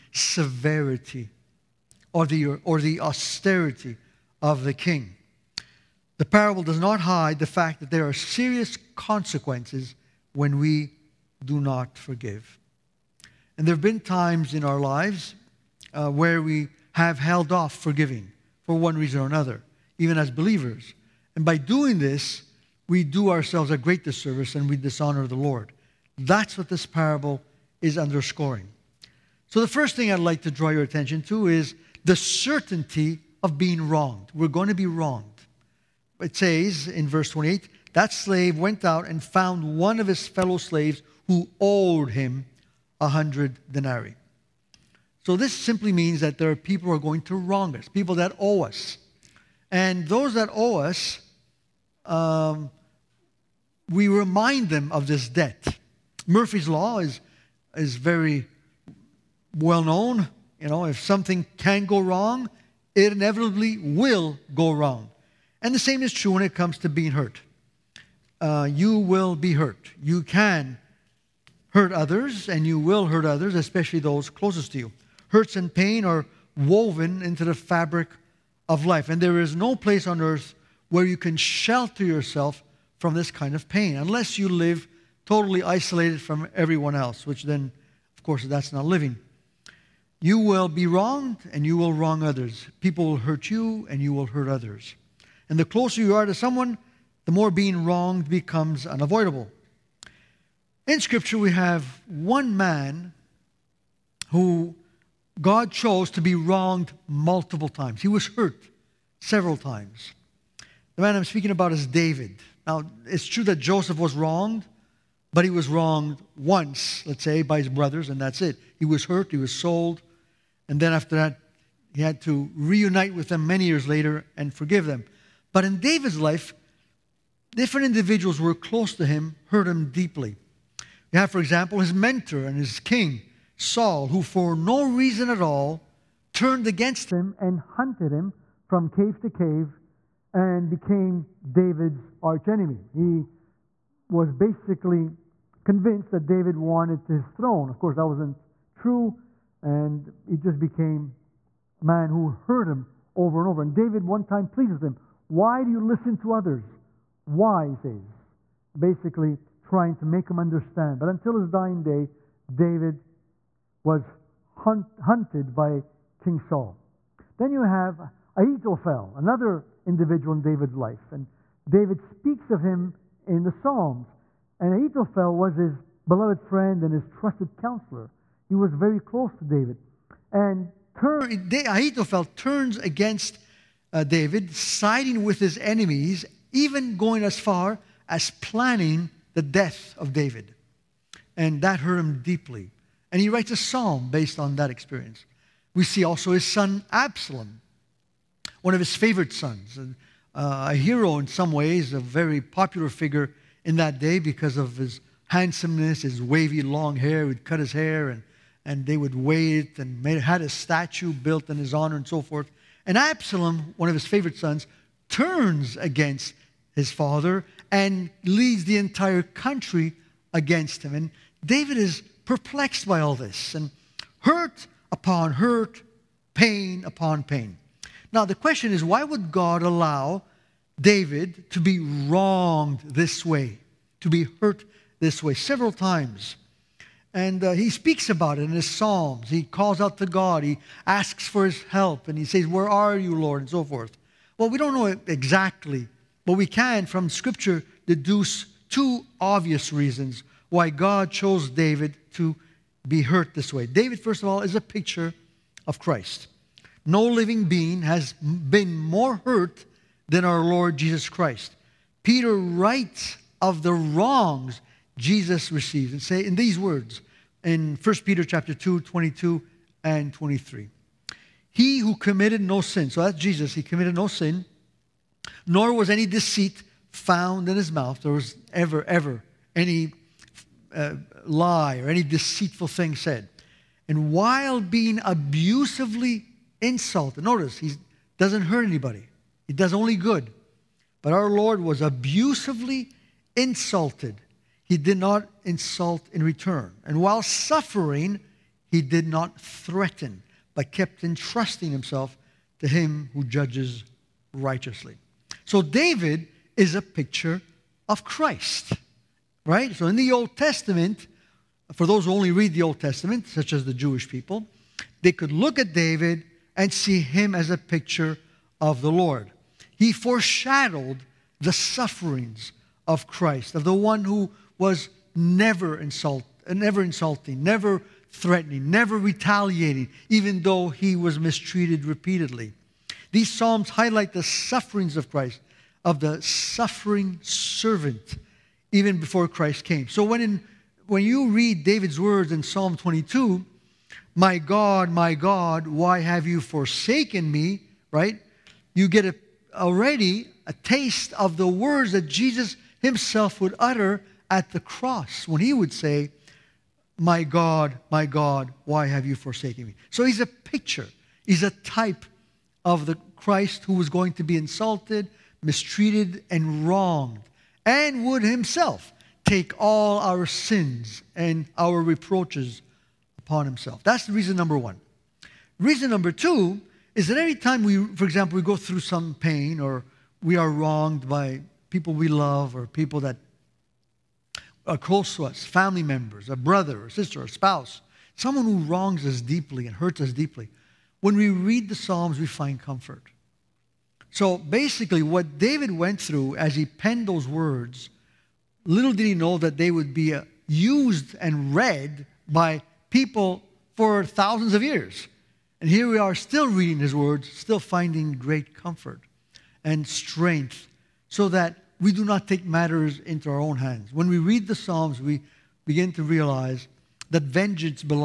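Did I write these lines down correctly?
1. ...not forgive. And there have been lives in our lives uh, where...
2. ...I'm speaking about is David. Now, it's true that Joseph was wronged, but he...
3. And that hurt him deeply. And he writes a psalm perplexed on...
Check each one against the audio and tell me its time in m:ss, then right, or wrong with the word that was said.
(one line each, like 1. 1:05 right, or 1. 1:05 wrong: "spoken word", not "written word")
1. 0:11 wrong: "times", not "lives"
2. 1:51 right
3. 3:11 wrong: "based", not "perplexed".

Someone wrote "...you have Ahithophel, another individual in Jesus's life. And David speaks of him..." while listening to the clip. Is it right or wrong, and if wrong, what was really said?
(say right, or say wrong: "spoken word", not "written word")
wrong: "David", not "Jesus".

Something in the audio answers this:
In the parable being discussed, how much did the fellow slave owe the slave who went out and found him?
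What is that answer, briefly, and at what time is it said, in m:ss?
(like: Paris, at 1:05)
100 denarii, at 0:43.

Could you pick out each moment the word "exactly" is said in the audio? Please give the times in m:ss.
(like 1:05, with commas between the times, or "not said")
4:05.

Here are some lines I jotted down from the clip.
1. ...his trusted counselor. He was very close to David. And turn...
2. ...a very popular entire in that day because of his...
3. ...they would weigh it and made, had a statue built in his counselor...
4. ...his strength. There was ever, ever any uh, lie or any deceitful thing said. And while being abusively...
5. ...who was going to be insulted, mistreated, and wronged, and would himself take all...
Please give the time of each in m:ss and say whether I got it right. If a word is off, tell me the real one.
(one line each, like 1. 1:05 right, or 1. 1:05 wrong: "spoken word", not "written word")
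1. 2:56 right
2. 3:21 wrong: "figure", not "entire"
3. 3:28 wrong: "honor", not "counselor"
4. 4:37 wrong: "mouth", not "strength"
5. 6:03 right.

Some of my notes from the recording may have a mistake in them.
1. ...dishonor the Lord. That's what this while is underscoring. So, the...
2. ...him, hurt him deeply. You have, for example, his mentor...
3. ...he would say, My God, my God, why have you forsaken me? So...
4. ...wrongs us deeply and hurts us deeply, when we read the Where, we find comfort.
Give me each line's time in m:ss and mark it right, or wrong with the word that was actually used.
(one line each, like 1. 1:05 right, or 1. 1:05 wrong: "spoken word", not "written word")
1. 0:24 wrong: "parable", not "while"
2. 2:09 right
3. 5:55 right
4. 6:28 wrong: "Psalms", not "Where".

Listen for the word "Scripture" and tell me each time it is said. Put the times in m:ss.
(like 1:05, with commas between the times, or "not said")
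1:40, 4:07.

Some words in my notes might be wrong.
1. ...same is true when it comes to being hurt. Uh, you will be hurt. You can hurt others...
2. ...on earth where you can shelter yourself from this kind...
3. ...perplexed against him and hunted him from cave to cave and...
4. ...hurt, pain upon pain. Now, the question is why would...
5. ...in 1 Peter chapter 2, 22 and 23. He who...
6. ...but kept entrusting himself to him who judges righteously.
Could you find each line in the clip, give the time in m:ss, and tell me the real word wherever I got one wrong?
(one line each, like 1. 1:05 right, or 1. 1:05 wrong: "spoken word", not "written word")
1. 1:05 right
2. 1:20 right
3. 2:16 wrong: "turned", not "perplexed"
4. 3:45 right
5. 4:27 right
6. 5:00 right.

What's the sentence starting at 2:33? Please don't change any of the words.
And David one time pleads with him, Why do you listen to others?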